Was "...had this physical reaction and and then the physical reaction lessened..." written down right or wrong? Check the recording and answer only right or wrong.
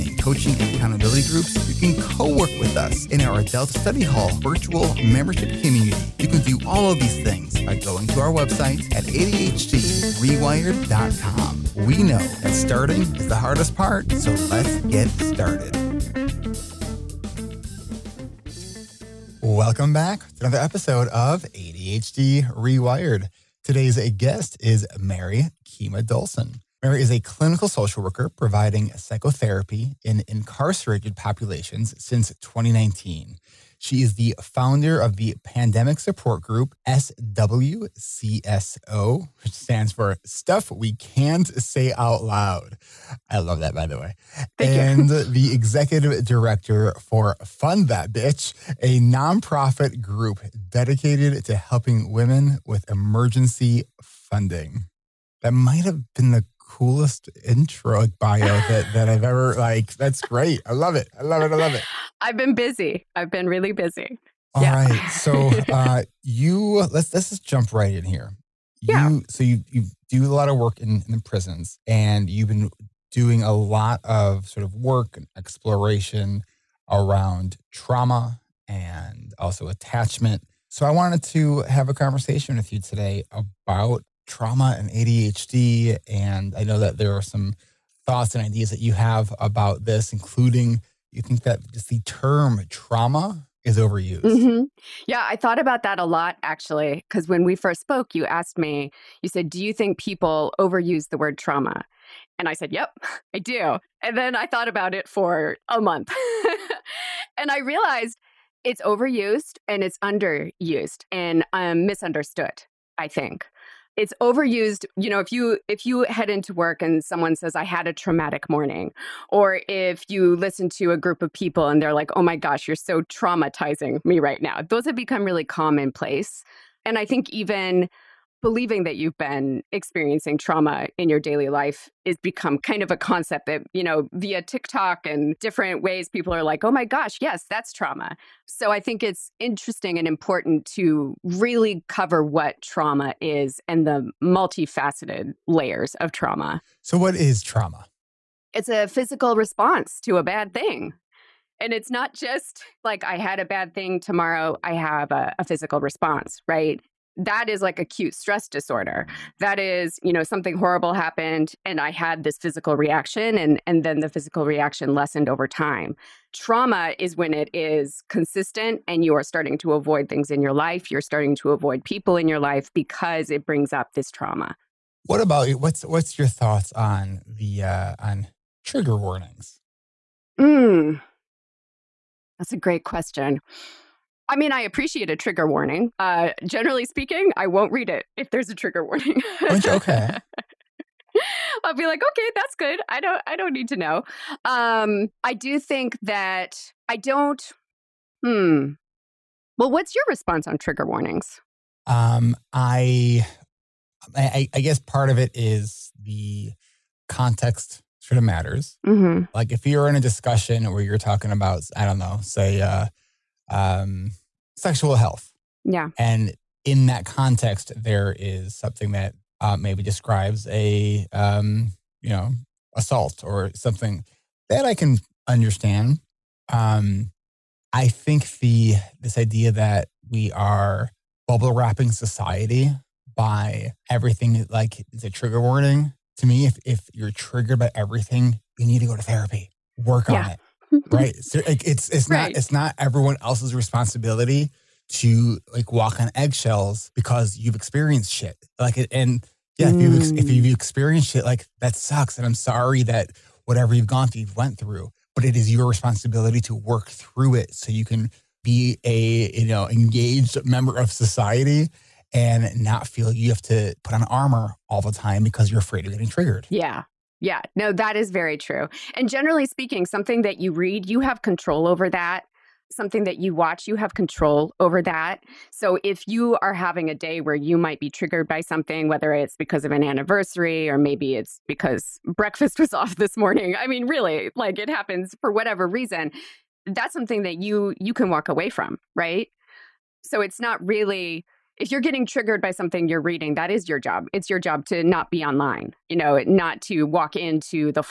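right.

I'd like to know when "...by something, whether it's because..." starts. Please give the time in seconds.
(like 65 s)
278 s.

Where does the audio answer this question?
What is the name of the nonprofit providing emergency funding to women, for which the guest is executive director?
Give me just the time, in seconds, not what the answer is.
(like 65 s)
47 s.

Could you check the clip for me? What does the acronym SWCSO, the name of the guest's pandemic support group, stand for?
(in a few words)
Stuff We Can't Say Out Loud.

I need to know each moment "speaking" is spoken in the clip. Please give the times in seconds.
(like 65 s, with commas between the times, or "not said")
186 s, 269 s.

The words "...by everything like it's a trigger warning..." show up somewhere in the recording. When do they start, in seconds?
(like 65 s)
233 s.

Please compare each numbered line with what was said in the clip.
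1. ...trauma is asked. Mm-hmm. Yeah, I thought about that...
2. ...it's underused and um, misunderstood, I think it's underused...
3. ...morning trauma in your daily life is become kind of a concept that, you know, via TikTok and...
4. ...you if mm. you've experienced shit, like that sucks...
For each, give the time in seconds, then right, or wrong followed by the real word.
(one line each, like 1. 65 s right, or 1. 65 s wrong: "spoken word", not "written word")
1. 92 s wrong: "overused", not "asked"
2. 109 s wrong: "overused", not "underused"
3. 129 s wrong: "experiencing", not "morning"
4. 249 s right.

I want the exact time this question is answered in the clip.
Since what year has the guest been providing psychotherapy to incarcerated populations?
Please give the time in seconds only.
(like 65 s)
32 s.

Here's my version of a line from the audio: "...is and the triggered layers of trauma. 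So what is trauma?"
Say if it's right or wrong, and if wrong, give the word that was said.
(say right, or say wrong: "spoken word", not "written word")
wrong: "multifaceted", not "triggered".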